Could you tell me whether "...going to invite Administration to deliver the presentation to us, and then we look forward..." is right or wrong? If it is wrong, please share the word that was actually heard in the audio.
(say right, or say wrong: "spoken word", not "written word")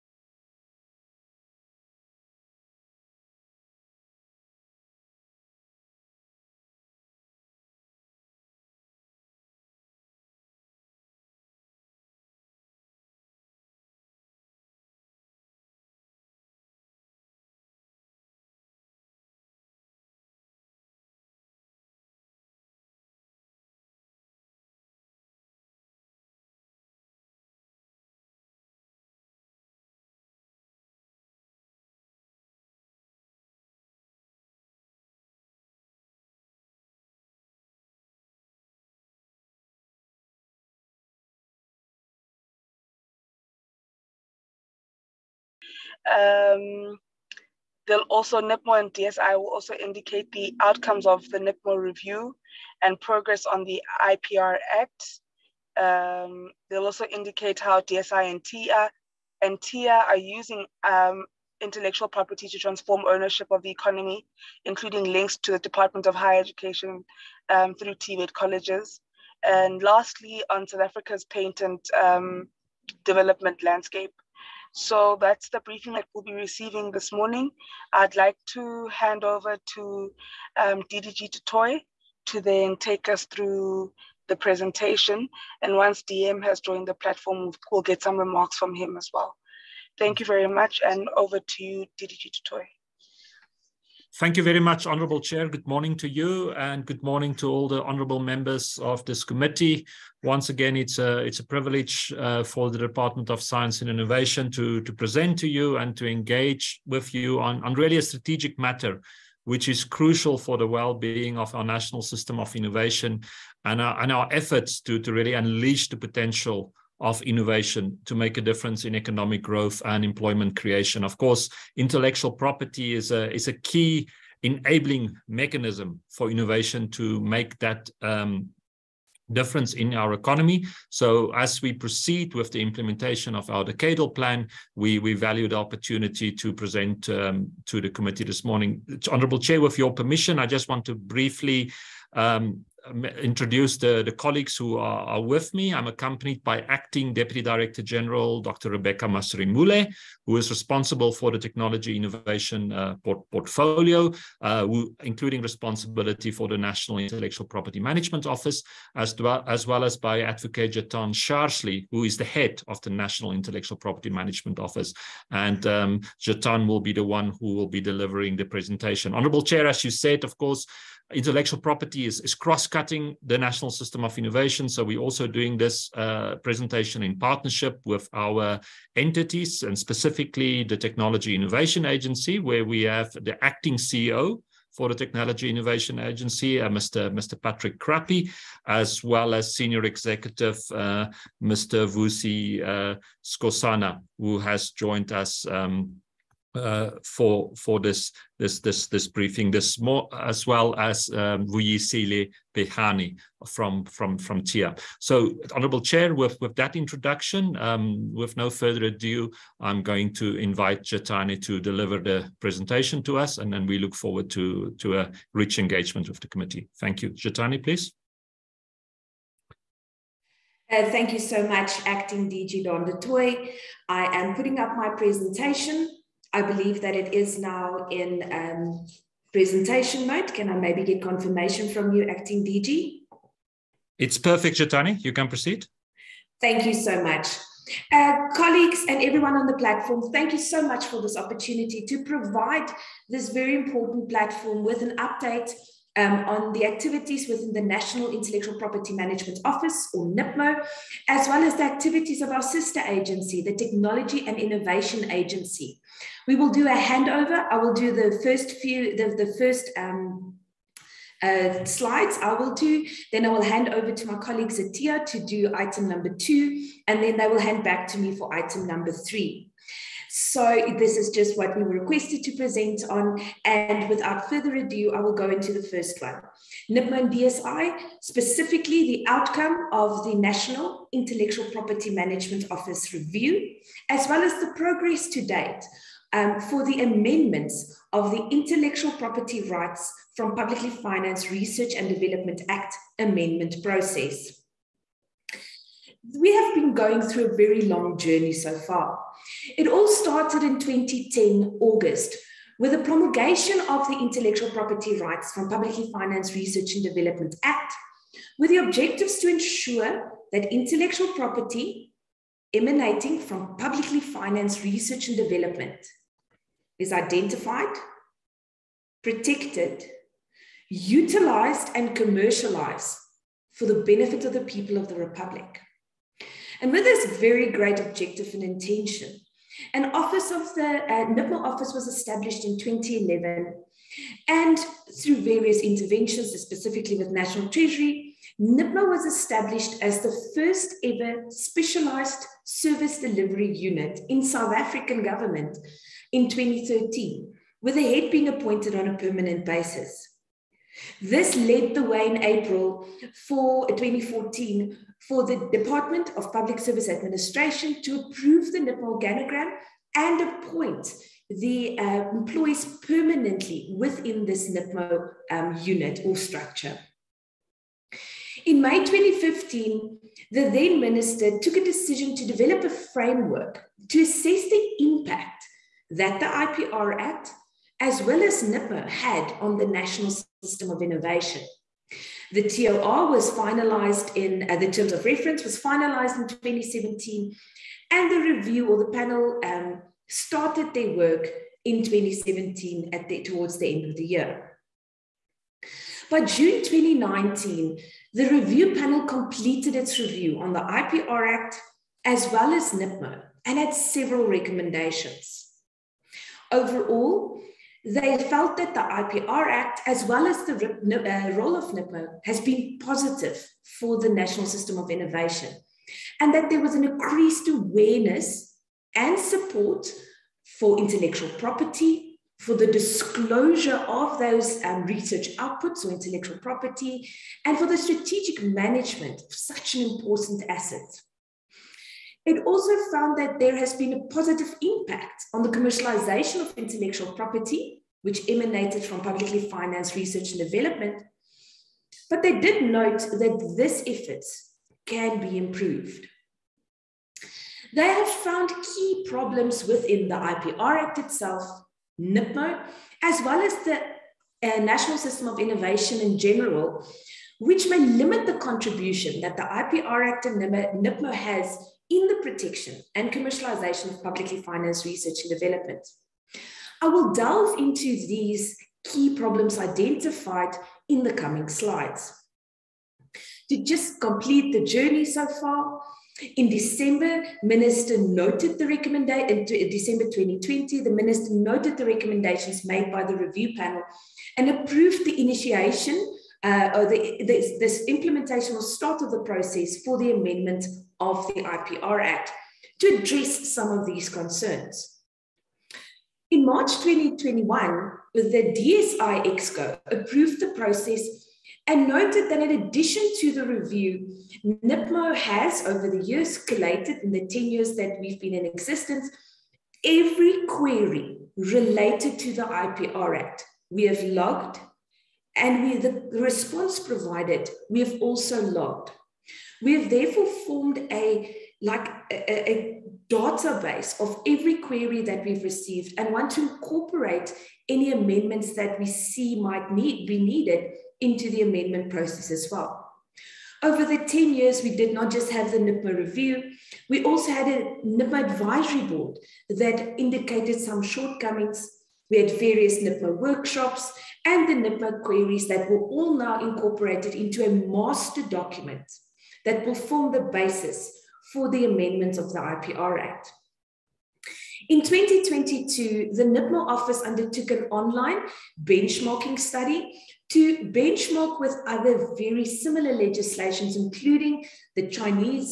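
wrong: "Jetane", not "Administration".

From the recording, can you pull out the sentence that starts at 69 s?
And lastly, on South Africa's patent um, development landscape.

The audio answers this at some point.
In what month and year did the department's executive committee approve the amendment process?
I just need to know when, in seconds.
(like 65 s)
496 s.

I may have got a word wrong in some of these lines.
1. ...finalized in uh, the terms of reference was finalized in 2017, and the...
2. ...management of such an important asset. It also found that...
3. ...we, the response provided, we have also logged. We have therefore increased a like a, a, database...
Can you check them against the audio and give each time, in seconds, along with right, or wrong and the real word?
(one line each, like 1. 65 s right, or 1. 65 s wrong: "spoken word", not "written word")
1. 383 s right
2. 428 s right
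3. 515 s wrong: "formed", not "increased".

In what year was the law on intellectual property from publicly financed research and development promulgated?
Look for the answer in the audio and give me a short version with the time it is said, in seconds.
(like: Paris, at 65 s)
2010, at 300 s.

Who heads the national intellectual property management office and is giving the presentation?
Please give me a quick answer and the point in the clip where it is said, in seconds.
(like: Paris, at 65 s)
Jetane Charsley, at 160 s.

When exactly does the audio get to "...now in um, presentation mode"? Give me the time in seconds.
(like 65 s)
227 s.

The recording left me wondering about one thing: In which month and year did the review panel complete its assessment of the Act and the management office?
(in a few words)
June 2019.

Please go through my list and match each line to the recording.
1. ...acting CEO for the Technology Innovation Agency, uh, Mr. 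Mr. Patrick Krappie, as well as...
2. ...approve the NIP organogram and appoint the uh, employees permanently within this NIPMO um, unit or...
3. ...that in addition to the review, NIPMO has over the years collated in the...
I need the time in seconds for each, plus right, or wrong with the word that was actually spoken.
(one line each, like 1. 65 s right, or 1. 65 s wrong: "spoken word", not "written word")
1. 183 s right
2. 357 s right
3. 502 s right.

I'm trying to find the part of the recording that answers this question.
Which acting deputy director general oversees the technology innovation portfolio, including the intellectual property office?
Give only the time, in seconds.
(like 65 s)
148 s.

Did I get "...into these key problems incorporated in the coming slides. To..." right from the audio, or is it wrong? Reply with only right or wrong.
wrong.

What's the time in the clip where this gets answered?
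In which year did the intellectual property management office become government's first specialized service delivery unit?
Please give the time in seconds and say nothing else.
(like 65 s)
346 s.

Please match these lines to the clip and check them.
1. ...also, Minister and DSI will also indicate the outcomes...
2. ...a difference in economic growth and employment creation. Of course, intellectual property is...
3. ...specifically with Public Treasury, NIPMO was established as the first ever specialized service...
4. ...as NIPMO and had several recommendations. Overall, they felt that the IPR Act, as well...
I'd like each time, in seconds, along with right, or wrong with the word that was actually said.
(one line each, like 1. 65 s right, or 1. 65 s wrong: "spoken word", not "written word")
1. 48 s wrong: "NIPMO", not "Minister"
2. 118 s right
3. 336 s wrong: "National", not "Public"
4. 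402 s right.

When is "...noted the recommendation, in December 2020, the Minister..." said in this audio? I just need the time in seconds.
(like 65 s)
477 s.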